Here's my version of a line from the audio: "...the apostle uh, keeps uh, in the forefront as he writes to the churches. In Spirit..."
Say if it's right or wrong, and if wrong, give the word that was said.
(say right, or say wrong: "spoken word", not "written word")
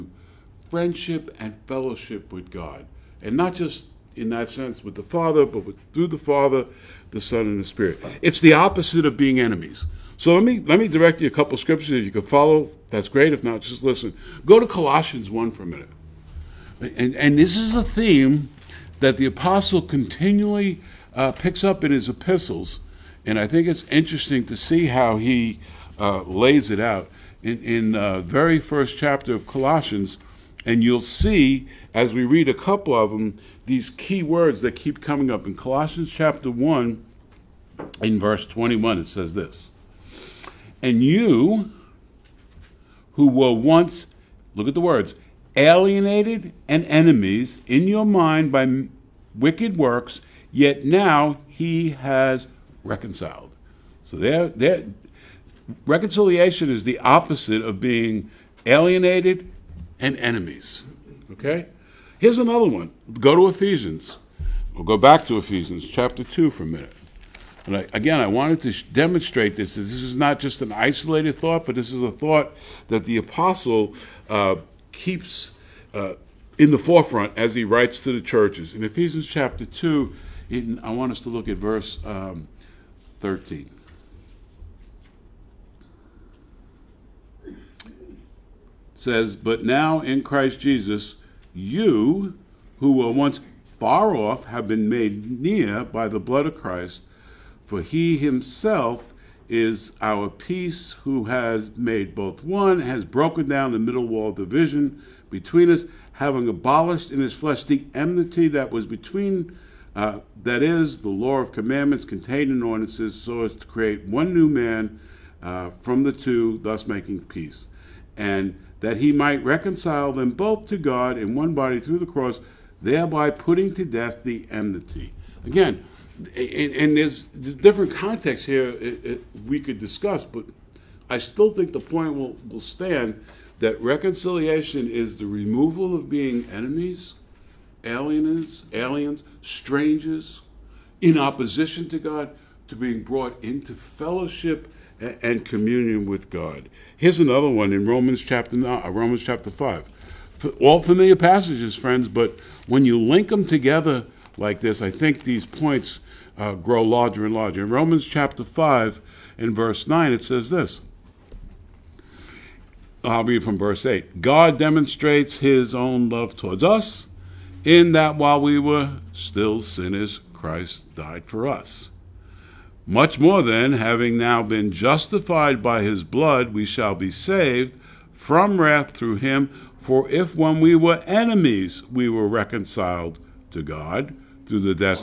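wrong: "Ephesians", not "Spirit".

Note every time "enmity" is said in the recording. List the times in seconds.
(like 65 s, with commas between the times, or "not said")
107 s, 124 s.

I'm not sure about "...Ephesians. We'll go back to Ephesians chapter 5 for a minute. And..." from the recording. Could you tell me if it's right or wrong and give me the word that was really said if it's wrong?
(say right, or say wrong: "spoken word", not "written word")
wrong: "2", not "5".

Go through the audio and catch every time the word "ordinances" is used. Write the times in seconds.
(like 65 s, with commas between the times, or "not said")
112 s.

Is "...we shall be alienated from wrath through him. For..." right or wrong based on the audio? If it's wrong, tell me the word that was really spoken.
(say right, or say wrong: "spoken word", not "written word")
wrong: "saved", not "alienated".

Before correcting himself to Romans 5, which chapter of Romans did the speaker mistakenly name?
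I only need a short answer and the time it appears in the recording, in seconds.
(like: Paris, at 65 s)
Romans 9, at 147 s.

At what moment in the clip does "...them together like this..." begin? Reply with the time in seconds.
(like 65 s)
153 s.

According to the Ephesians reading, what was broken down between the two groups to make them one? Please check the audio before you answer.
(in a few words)
the middle wall of division.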